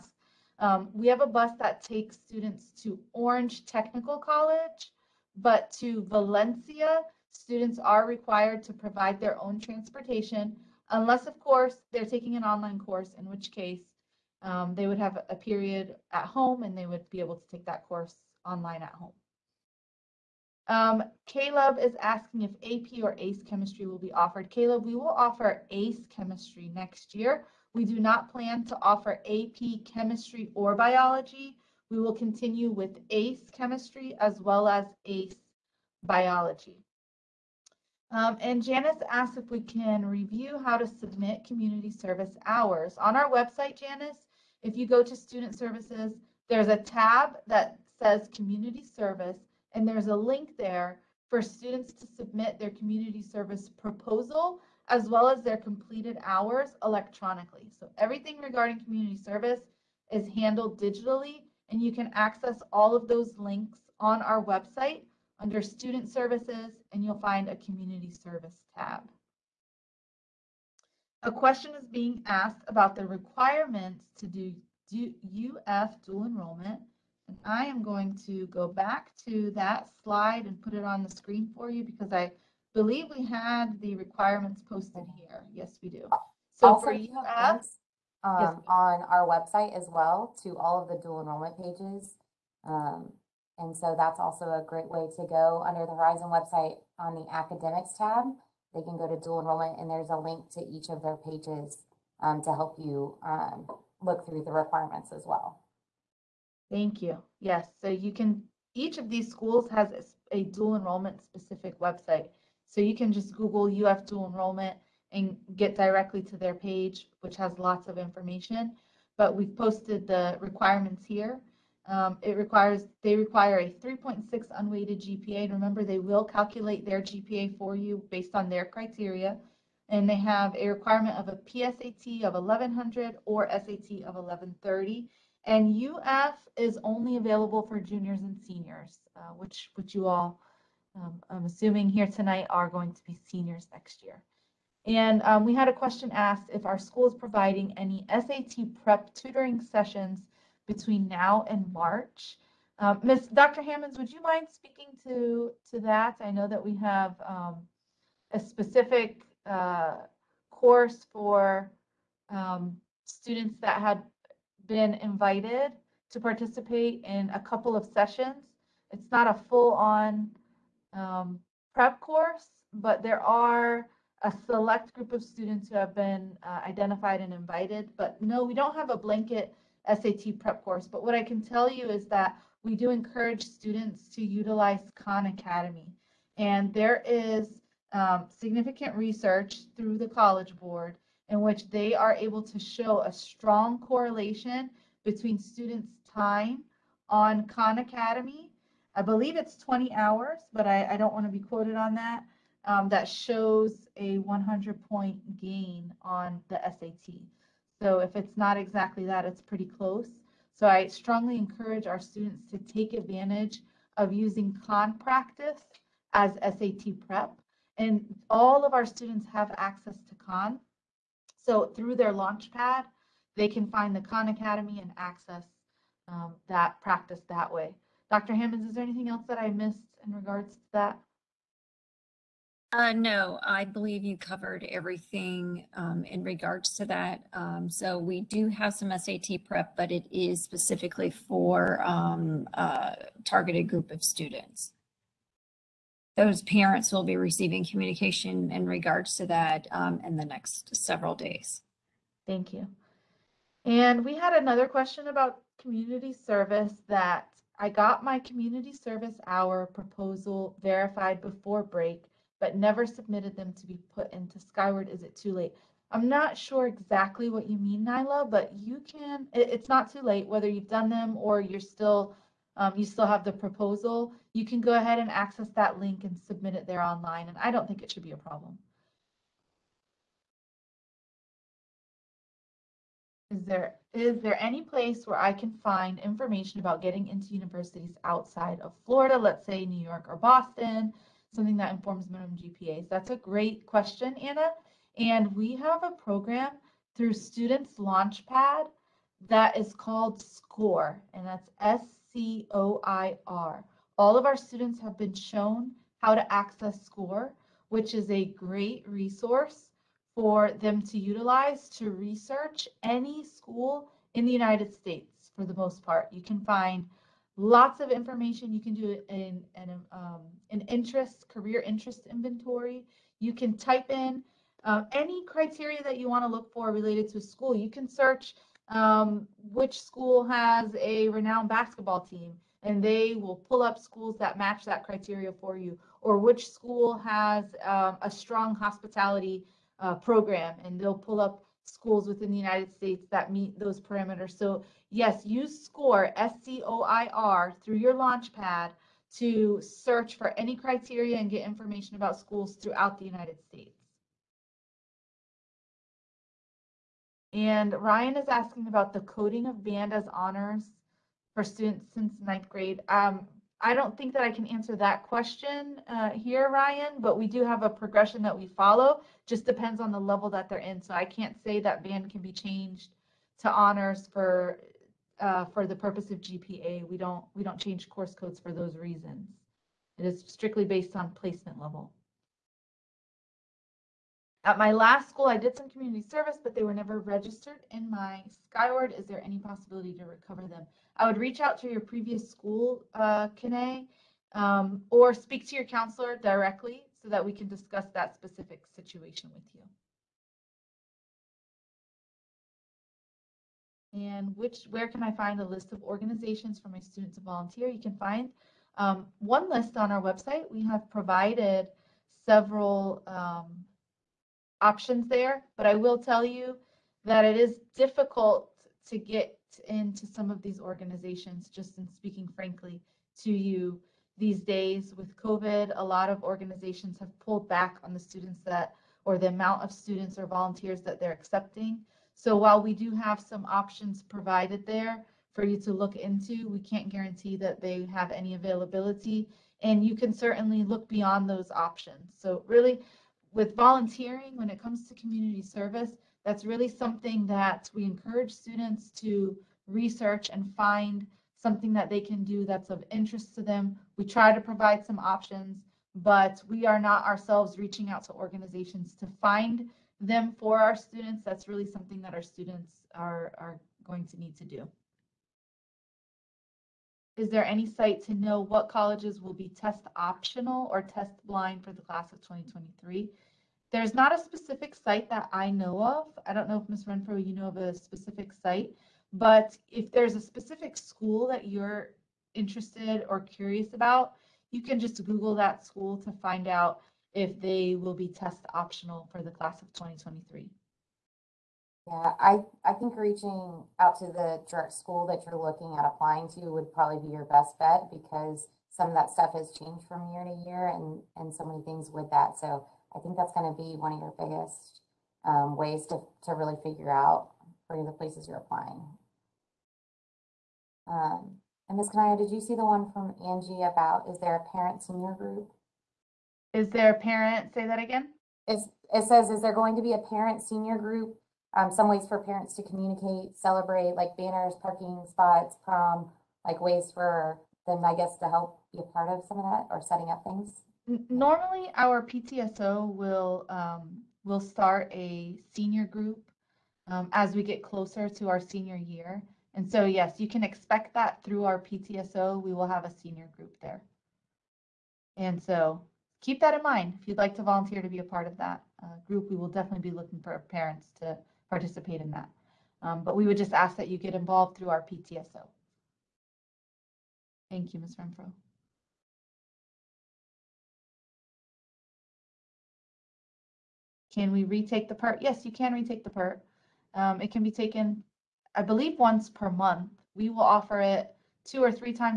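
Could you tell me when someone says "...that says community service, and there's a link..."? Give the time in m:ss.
0:47.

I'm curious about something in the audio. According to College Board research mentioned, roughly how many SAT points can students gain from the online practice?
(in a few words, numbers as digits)
100.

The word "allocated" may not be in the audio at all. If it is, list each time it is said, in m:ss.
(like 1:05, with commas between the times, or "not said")
not said.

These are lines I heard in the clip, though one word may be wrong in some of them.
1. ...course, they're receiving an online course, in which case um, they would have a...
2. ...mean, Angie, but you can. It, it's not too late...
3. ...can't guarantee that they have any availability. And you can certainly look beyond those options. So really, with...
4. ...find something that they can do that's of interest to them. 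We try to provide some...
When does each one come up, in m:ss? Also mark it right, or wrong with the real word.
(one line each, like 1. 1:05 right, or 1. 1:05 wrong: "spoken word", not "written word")
1. 0:11 wrong: "taking", not "receiving"
2. 4:27 wrong: "Nyla", not "Angie"
3. 7:16 right
4. 7:30 right.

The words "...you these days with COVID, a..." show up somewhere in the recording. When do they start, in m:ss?
7:03.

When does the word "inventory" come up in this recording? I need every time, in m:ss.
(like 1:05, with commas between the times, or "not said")
5:22.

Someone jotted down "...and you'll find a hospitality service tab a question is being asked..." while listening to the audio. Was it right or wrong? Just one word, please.
wrong.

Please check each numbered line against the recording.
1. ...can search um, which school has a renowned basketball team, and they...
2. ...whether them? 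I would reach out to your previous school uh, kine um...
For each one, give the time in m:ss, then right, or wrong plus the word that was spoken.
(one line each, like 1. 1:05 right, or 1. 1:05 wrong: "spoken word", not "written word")
1. 5:27 right
2. 6:30 wrong: "recover", not "whether".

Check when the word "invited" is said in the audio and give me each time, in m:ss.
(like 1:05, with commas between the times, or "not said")
2:44, 2:57.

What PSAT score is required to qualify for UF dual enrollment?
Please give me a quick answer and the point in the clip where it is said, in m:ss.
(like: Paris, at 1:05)
1100, at 2:12.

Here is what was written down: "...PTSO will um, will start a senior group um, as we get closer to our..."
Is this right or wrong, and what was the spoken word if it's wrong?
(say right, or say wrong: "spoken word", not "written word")
right.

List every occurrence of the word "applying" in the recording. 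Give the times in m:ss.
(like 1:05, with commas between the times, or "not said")
8:15, 8:28.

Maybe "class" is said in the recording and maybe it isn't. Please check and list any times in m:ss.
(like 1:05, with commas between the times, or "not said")
7:51, 8:09.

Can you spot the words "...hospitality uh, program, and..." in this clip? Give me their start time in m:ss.
5:38.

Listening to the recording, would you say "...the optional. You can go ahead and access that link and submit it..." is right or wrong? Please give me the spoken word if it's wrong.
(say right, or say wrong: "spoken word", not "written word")
wrong: "proposal", not "optional".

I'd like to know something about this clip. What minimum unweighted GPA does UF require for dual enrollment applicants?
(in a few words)
3.6.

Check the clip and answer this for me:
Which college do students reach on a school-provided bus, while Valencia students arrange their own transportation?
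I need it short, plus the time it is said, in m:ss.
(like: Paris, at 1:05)
Orange Technical College, at 0:03.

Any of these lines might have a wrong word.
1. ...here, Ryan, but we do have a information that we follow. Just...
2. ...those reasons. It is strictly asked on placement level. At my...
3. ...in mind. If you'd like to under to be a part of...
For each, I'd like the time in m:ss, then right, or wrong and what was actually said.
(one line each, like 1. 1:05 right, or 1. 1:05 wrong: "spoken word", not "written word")
1. 6:06 wrong: "progression", not "information"
2. 6:18 wrong: "based", not "asked"
3. 9:06 wrong: "volunteer", not "under".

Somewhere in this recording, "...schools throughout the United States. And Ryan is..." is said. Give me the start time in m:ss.
5:52.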